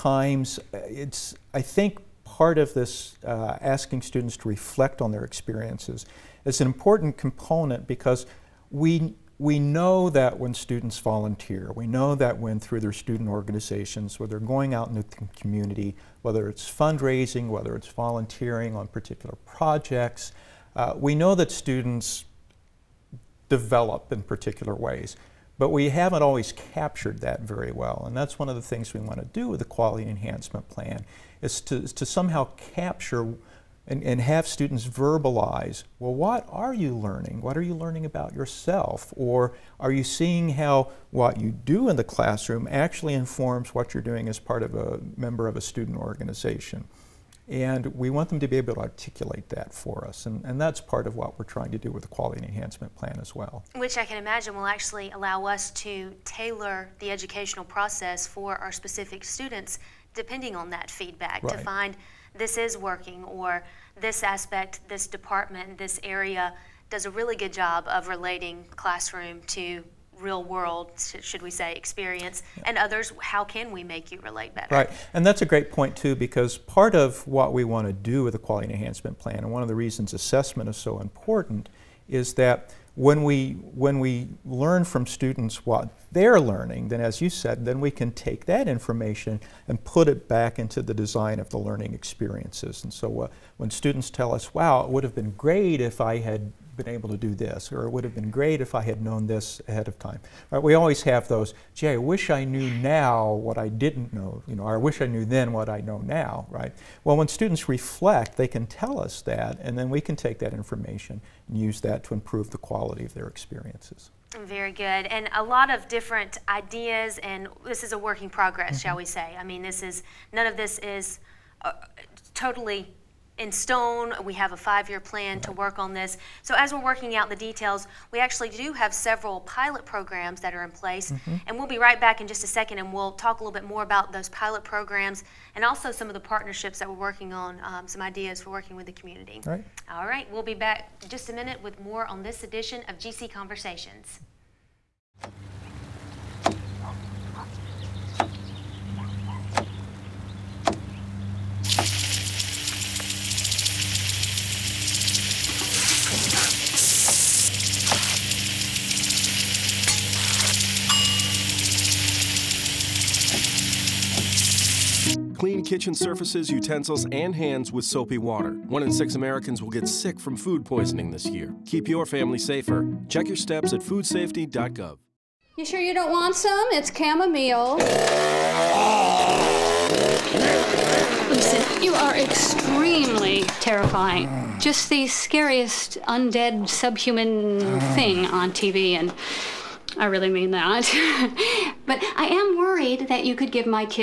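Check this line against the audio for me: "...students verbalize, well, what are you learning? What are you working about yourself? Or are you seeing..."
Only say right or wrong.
wrong.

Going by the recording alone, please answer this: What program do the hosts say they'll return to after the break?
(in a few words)
GC Conversations.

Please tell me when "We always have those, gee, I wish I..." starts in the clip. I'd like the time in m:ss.
1:40.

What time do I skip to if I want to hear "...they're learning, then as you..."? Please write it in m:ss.
1:26.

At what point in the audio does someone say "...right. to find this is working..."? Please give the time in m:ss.
1:01.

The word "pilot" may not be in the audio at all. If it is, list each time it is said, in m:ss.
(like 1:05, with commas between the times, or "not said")
2:09, 2:14.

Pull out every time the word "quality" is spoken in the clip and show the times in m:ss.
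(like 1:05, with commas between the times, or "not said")
0:29, 0:52, 1:18, 1:52.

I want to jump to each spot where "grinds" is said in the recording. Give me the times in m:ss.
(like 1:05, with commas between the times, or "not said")
not said.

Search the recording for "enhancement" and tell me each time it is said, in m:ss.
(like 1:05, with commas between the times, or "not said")
0:30, 0:52, 1:18.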